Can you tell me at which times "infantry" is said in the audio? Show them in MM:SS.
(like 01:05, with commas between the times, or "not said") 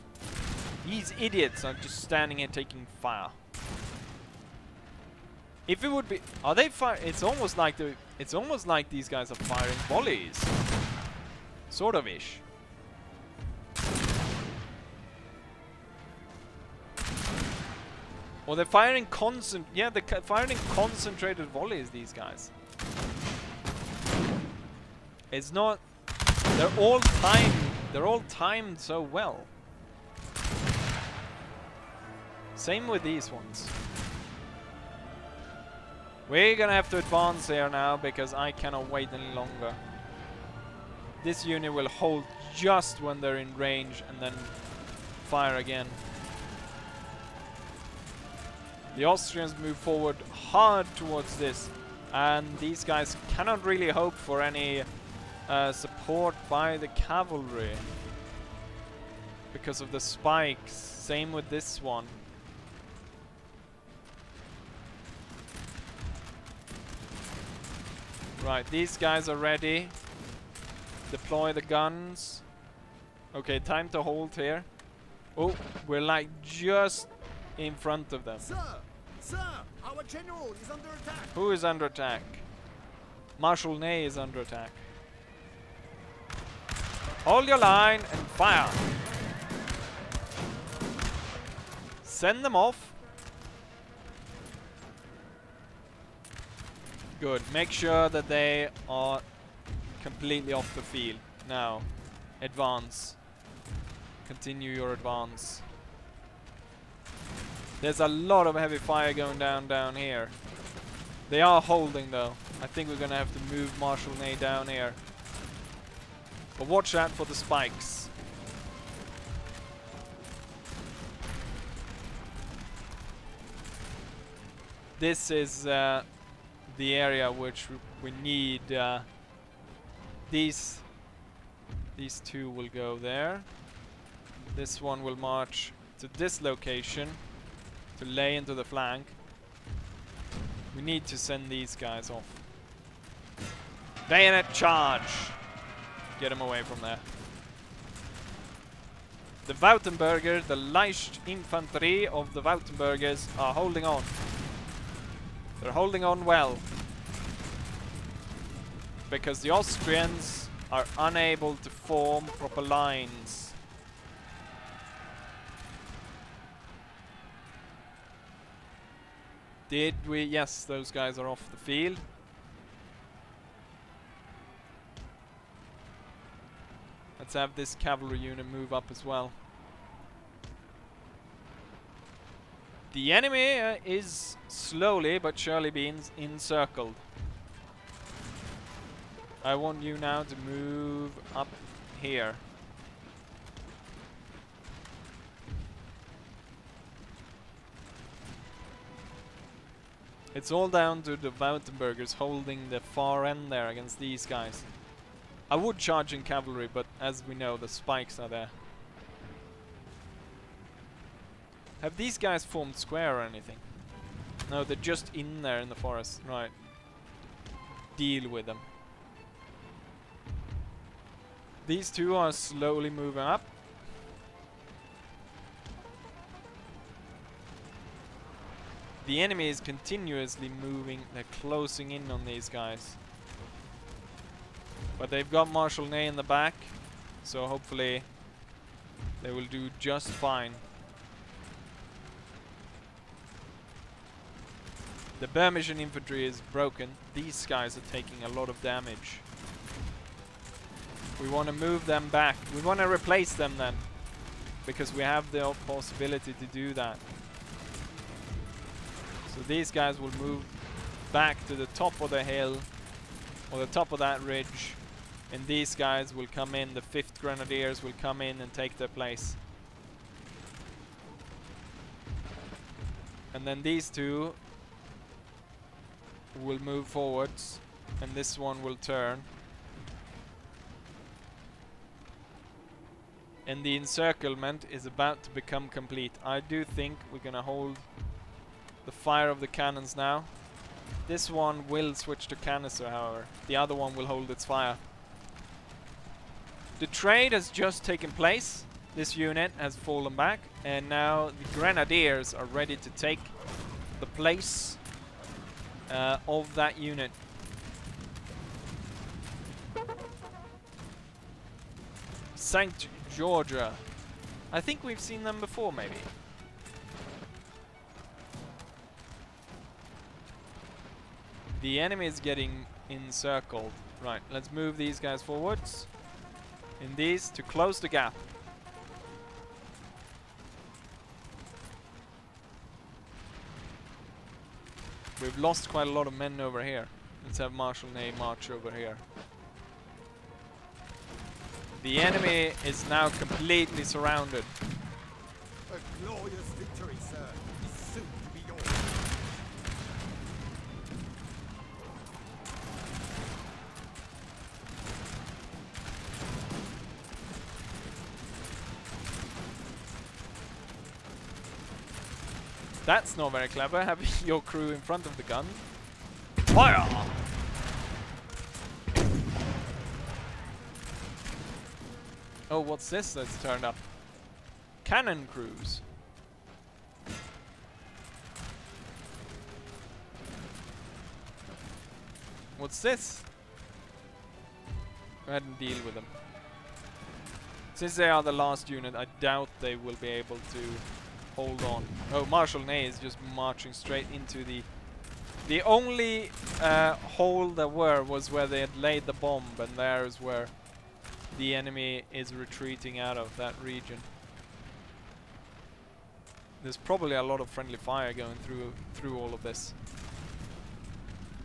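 02:31, 04:05.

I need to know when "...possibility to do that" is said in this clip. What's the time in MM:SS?
04:15.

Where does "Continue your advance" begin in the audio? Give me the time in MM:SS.
01:44.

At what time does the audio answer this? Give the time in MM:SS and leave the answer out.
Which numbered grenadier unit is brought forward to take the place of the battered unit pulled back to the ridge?
04:26.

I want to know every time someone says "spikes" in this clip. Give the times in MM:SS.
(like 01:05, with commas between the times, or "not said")
00:59, 01:57, 03:27.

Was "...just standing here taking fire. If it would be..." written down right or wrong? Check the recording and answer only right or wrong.
right.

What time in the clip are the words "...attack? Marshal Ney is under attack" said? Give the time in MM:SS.
01:21.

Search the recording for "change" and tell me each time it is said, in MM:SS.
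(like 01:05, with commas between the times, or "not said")
not said.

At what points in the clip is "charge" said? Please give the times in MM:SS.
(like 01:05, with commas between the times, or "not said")
02:24, 03:25.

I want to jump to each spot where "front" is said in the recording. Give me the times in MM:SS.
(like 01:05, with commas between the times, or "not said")
01:17, 06:04.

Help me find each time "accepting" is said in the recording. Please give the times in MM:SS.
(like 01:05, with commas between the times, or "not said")
not said.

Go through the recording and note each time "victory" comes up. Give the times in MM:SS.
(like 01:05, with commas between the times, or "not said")
05:46.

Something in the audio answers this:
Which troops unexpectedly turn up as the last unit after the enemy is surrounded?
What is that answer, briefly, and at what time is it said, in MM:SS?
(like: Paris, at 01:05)
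Cannon crews, at 06:14.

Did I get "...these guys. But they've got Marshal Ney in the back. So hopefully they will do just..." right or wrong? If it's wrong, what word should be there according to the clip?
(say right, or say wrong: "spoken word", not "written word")
right.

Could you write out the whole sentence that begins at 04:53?
The other one will hold its fire.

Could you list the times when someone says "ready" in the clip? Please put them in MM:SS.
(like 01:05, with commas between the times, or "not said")
01:09, 05:02.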